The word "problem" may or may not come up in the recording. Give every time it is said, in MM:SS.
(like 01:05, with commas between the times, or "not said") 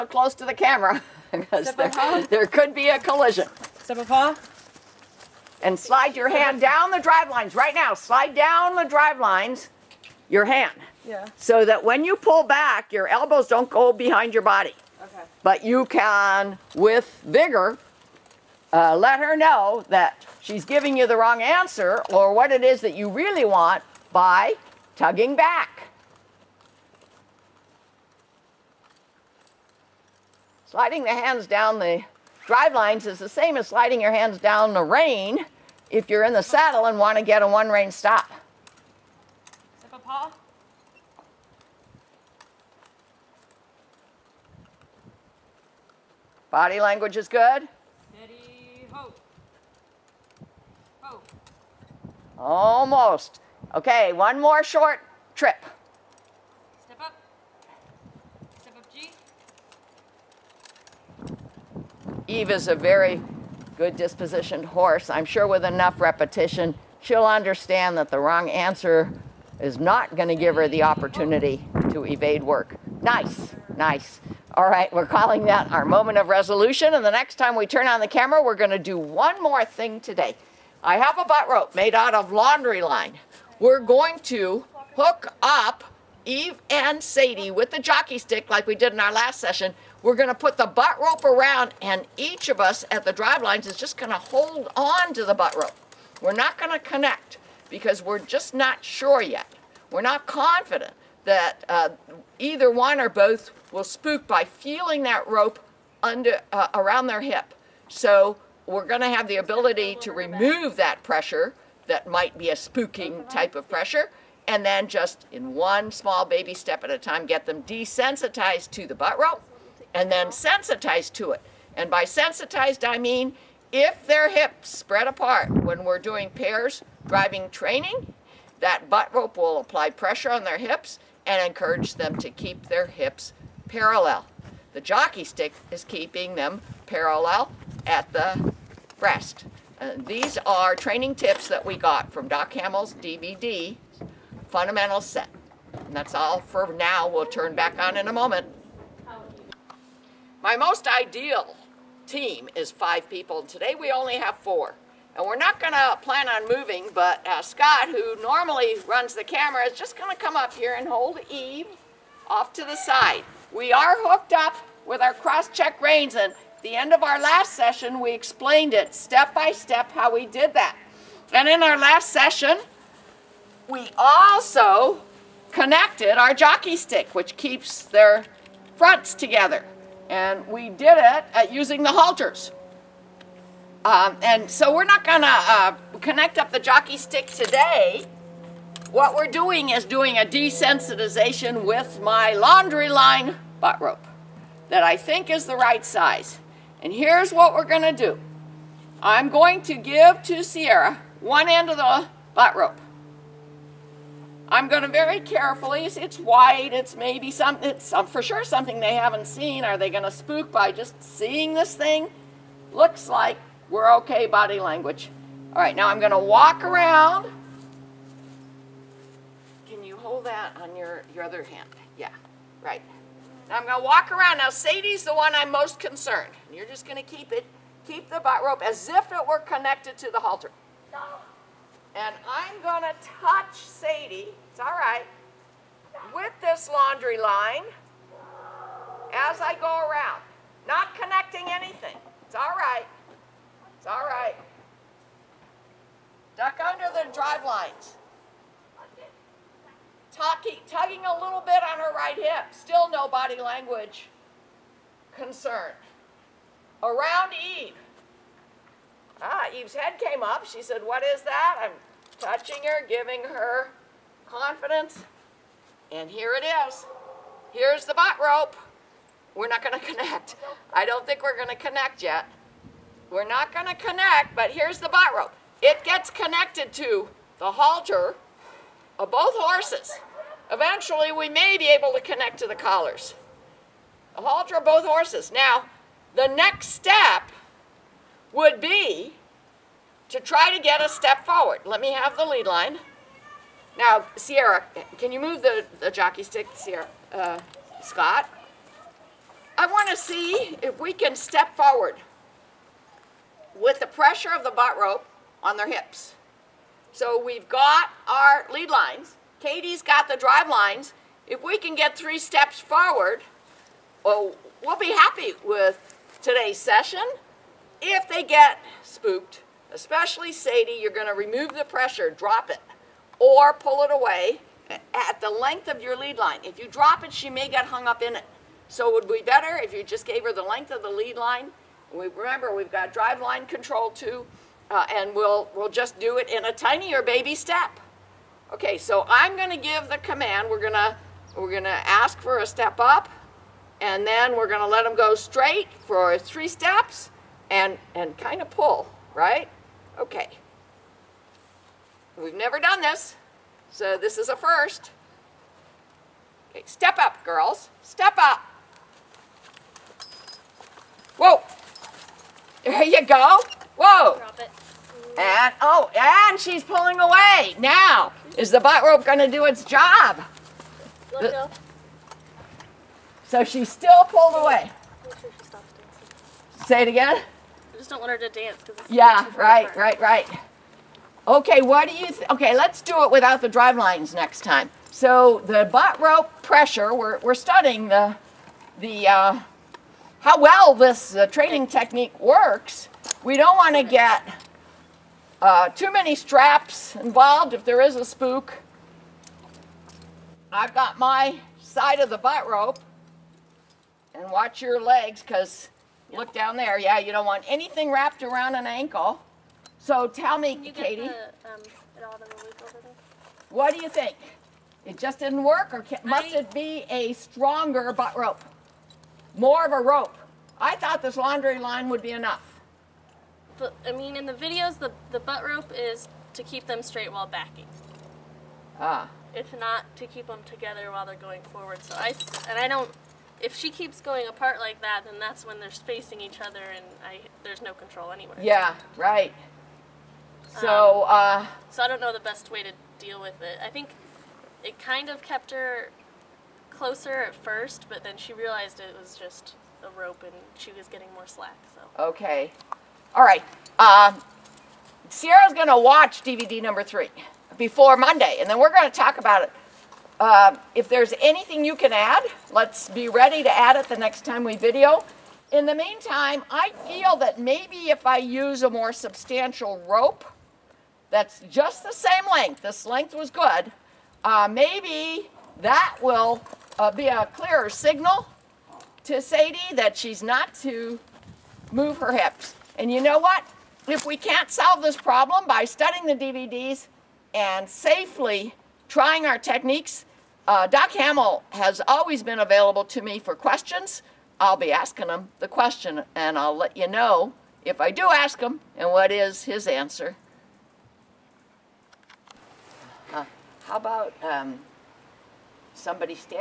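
08:04.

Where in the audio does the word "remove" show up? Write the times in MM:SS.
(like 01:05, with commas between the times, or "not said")
01:50, 05:21.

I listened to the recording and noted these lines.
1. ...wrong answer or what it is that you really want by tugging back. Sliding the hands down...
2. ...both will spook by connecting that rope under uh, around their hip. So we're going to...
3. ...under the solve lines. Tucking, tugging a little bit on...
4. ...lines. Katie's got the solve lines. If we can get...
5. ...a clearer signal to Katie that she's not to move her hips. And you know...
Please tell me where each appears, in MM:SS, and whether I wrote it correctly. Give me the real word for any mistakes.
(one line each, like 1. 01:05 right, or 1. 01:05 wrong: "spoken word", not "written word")
1. 00:21 right
2. 01:43 wrong: "feeling", not "connecting"
3. 04:06 wrong: "drive", not "solve"
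4. 05:08 wrong: "drive", not "solve"
5. 07:57 wrong: "Sadie", not "Katie".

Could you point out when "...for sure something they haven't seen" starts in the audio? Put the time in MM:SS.
03:28.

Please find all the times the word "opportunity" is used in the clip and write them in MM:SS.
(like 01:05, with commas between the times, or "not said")
01:10.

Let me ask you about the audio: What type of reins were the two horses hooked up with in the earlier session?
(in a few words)
cross-check reins.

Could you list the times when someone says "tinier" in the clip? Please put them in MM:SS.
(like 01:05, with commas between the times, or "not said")
05:36.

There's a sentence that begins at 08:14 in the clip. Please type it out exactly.
I'll be asking him the question, and I'll let you know if I do ask him and what is his answer.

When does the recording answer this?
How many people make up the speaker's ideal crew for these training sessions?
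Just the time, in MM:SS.
02:32.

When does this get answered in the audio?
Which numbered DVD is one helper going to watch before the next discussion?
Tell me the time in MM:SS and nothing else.
07:36.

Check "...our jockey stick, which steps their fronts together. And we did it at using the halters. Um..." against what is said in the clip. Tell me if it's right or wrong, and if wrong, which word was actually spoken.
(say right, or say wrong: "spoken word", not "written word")
wrong: "keeps", not "steps".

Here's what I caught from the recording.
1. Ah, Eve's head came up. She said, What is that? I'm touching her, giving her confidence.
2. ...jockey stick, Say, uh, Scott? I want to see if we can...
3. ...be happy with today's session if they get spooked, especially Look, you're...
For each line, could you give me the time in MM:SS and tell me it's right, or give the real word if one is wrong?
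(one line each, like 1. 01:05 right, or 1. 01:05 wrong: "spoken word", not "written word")
1. 04:19 right
2. 04:55 wrong: "Sierra", not "Say"
3. 05:14 wrong: "Sadie", not "Look".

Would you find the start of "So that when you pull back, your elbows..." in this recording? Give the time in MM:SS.
00:11.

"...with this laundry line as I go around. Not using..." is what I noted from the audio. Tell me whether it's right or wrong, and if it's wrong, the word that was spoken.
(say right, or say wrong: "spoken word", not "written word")
wrong: "connecting", not "using".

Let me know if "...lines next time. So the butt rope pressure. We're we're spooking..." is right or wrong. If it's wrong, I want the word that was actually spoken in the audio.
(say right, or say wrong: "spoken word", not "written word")
wrong: "studying", not "spooking".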